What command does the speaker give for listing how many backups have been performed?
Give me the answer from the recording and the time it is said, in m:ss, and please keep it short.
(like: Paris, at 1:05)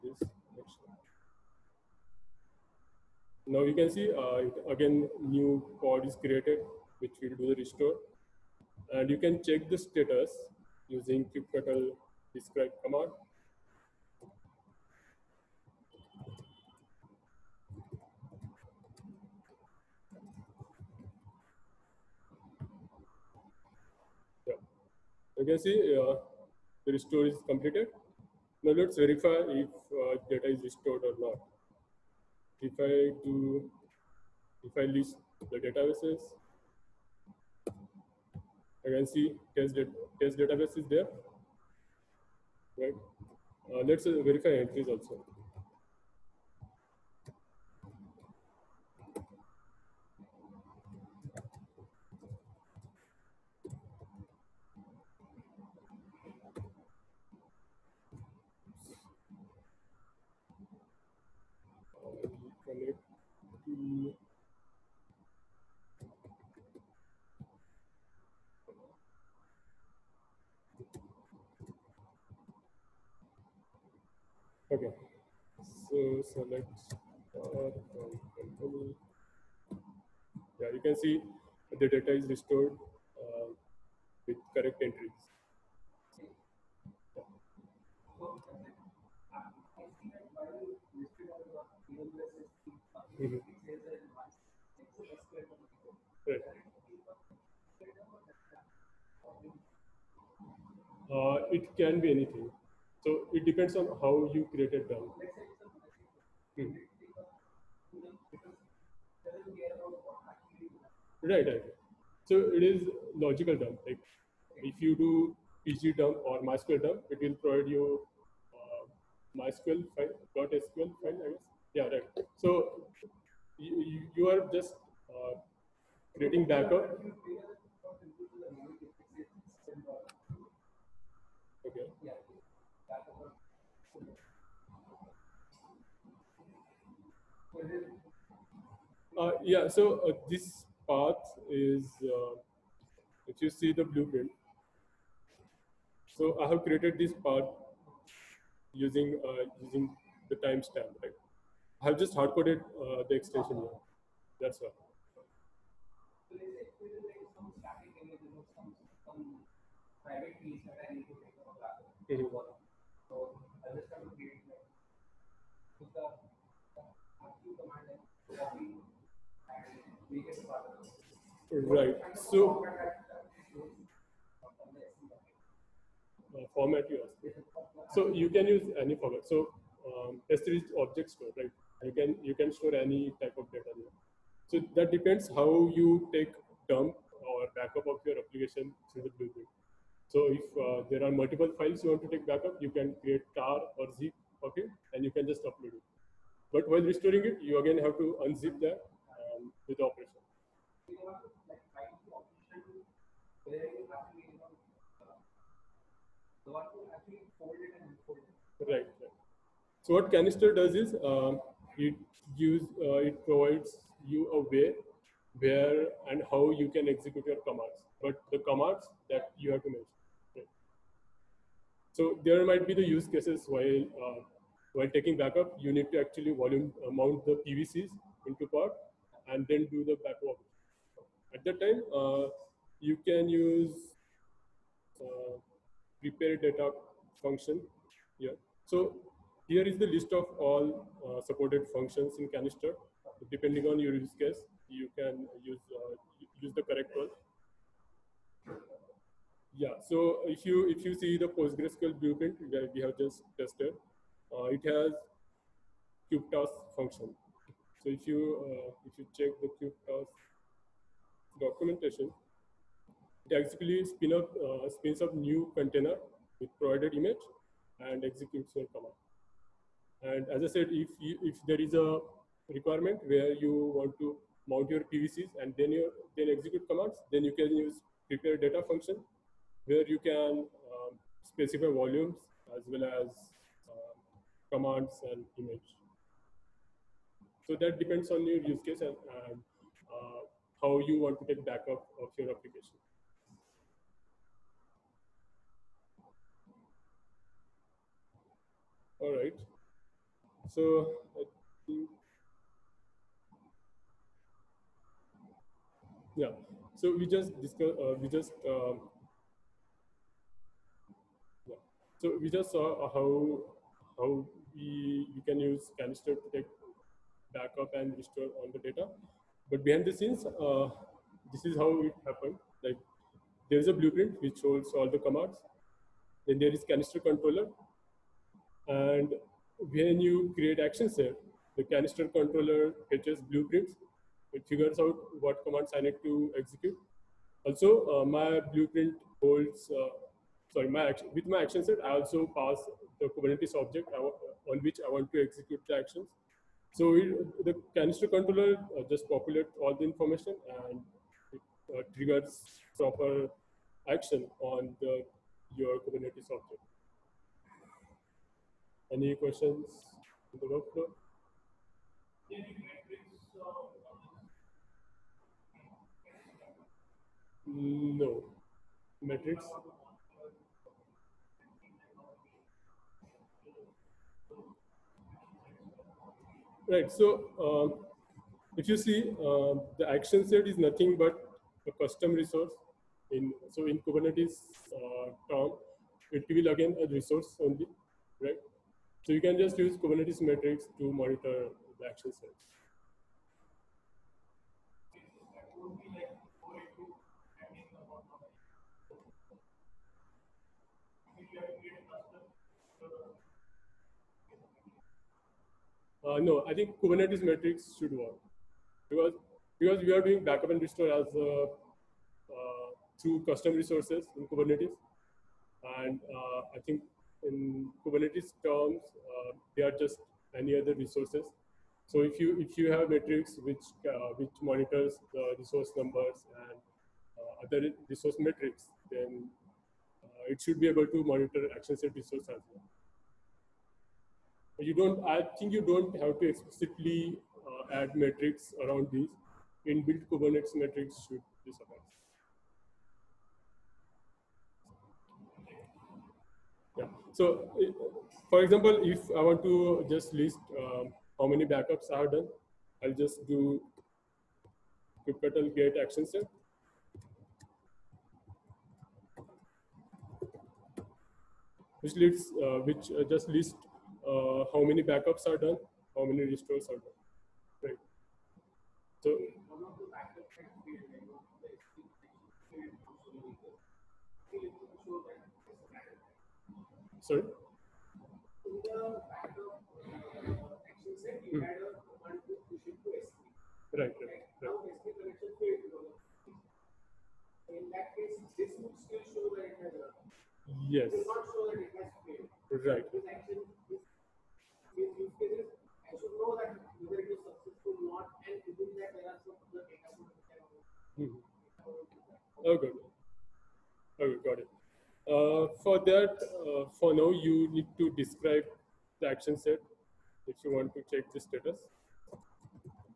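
kubectl get action set, at 7:35.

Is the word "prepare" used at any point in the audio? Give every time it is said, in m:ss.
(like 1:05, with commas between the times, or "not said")
3:56, 4:38.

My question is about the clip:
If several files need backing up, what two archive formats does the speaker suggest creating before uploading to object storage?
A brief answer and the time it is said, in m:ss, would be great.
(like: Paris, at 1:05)
tar or zip, at 3:13.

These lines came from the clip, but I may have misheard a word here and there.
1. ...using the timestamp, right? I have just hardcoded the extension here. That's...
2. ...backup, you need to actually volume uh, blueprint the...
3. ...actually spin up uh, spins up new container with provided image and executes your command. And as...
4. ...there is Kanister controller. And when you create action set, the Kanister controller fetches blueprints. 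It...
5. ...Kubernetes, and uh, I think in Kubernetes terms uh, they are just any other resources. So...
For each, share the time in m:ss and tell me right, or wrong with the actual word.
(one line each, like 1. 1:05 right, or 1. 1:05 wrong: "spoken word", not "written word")
1. 2:29 right
2. 3:45 wrong: "mount", not "blueprint"
3. 4:23 right
4. 5:26 right
5. 6:54 right.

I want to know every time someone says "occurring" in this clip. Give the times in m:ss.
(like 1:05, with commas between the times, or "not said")
not said.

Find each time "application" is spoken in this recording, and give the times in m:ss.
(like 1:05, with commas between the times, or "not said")
3:08, 4:52.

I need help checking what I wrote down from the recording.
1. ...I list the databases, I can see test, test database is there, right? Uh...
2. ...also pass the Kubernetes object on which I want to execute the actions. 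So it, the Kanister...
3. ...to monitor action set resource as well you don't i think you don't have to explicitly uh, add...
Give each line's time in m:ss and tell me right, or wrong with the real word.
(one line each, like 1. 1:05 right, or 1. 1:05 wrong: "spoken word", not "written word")
1. 0:34 right
2. 5:41 right
3. 7:10 right.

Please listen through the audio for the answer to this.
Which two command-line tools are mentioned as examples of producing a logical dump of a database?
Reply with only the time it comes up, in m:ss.
1:55.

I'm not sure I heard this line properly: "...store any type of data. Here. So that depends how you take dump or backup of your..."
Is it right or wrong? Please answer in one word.
right.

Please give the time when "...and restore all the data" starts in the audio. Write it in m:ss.
5:17.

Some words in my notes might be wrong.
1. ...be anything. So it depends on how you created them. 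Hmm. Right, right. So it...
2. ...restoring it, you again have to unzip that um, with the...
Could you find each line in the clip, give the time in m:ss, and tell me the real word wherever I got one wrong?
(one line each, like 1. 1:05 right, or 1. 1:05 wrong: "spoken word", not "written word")
1. 1:42 right
2. 3:16 right.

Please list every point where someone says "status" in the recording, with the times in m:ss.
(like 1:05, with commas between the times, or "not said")
0:09, 8:31.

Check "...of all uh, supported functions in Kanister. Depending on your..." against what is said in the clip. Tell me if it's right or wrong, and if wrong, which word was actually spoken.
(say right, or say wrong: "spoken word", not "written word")
right.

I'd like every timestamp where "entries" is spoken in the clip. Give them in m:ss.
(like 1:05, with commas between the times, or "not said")
0:44, 1:24.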